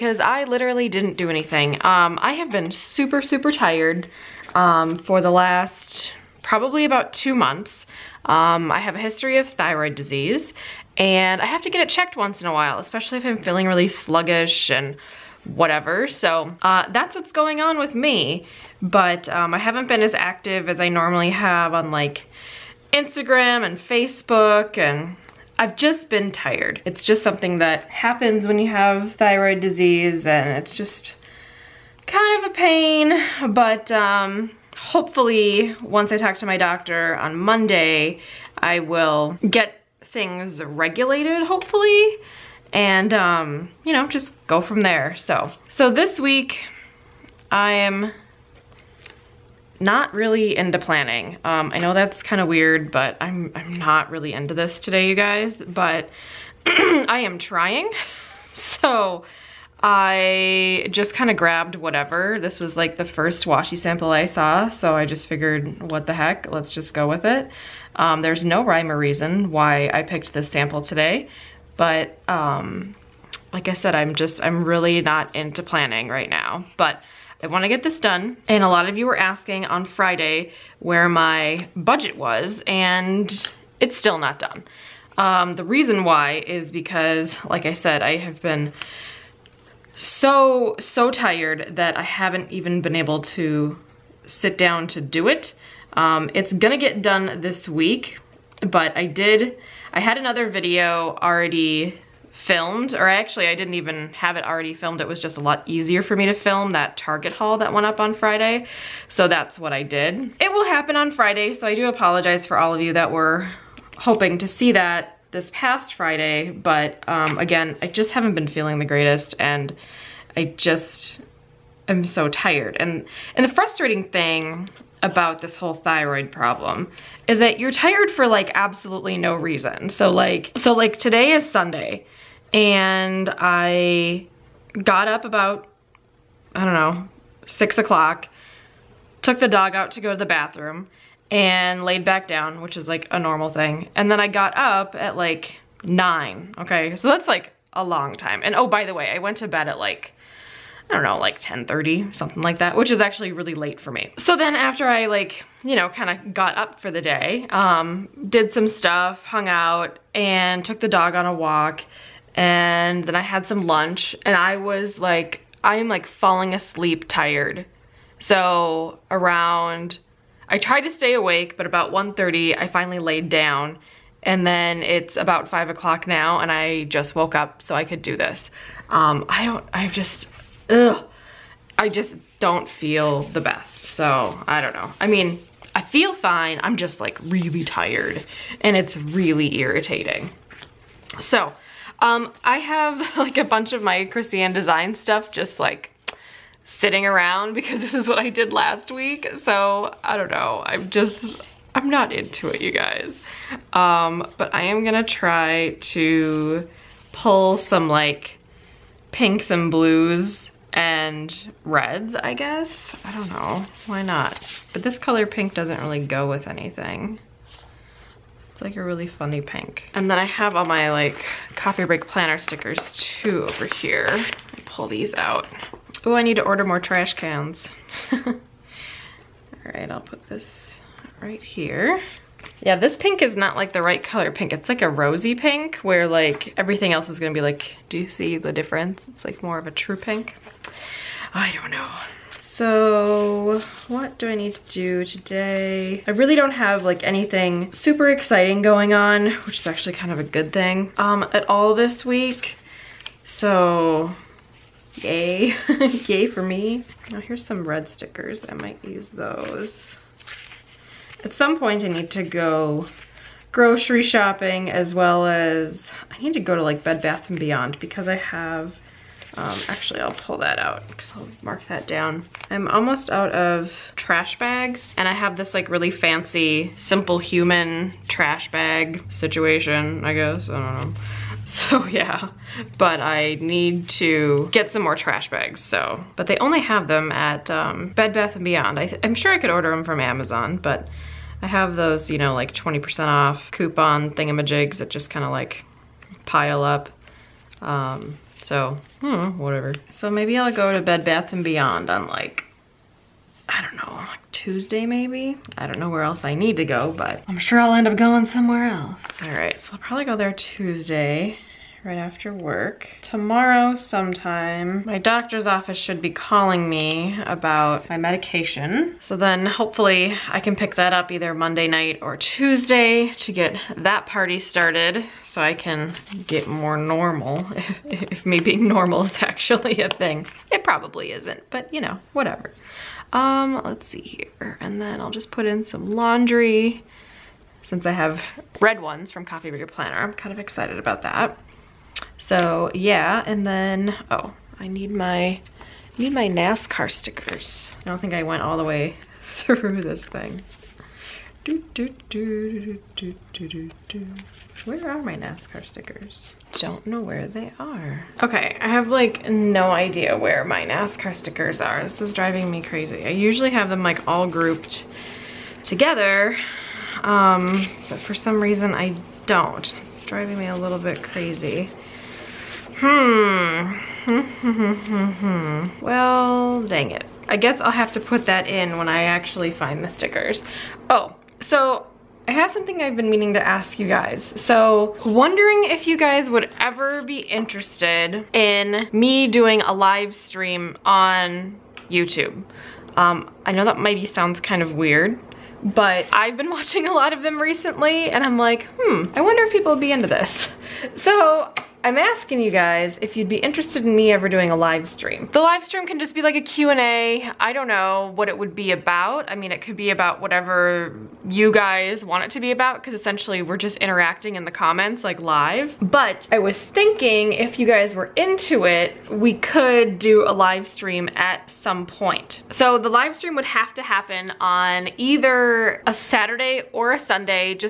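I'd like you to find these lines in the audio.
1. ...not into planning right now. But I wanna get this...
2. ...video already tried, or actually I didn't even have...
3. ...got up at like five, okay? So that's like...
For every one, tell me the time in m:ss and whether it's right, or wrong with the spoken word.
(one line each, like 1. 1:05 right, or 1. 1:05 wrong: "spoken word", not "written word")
1. 1:15 right
2. 1:40 wrong: "filmed", not "tried"
3. 2:24 wrong: "nine", not "five".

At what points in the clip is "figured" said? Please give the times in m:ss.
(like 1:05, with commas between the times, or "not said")
1:05.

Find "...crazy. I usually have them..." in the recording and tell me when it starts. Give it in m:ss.
6:02.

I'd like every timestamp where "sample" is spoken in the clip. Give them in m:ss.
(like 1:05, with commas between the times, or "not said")
1:03, 1:10.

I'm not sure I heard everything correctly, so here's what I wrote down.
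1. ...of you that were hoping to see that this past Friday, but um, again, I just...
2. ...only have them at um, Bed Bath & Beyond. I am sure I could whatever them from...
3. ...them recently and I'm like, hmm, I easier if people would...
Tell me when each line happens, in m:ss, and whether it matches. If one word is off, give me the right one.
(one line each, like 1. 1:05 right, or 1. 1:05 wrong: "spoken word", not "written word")
1. 1:52 right
2. 4:46 wrong: "order", not "whatever"
3. 6:37 wrong: "wonder", not "easier".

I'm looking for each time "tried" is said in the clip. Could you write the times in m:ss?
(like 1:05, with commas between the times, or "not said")
2:50.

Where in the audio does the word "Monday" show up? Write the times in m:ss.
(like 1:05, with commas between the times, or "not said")
0:37, 5:21.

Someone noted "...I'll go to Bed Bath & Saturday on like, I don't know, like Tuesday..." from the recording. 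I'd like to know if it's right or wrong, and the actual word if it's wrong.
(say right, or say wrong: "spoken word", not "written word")
wrong: "Beyond", not "Saturday".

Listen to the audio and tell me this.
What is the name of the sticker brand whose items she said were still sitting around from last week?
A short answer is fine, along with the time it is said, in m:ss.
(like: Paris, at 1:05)
Krissyanne Design, at 3:14.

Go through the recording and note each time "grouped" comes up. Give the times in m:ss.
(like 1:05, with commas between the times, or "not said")
6:04.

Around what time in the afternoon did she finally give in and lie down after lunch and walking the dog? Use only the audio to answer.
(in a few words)
1:30.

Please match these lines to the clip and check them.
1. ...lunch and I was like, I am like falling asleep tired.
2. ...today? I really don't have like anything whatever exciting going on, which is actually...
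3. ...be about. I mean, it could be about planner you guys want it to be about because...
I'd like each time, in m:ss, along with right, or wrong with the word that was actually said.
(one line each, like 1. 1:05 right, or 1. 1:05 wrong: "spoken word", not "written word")
1. 2:43 right
2. 4:05 wrong: "super", not "whatever"
3. 6:48 wrong: "whatever", not "planner".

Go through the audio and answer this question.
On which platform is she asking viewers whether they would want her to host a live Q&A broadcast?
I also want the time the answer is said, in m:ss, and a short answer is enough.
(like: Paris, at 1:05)
YouTube, at 6:31.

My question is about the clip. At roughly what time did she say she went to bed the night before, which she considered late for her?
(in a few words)
10:30.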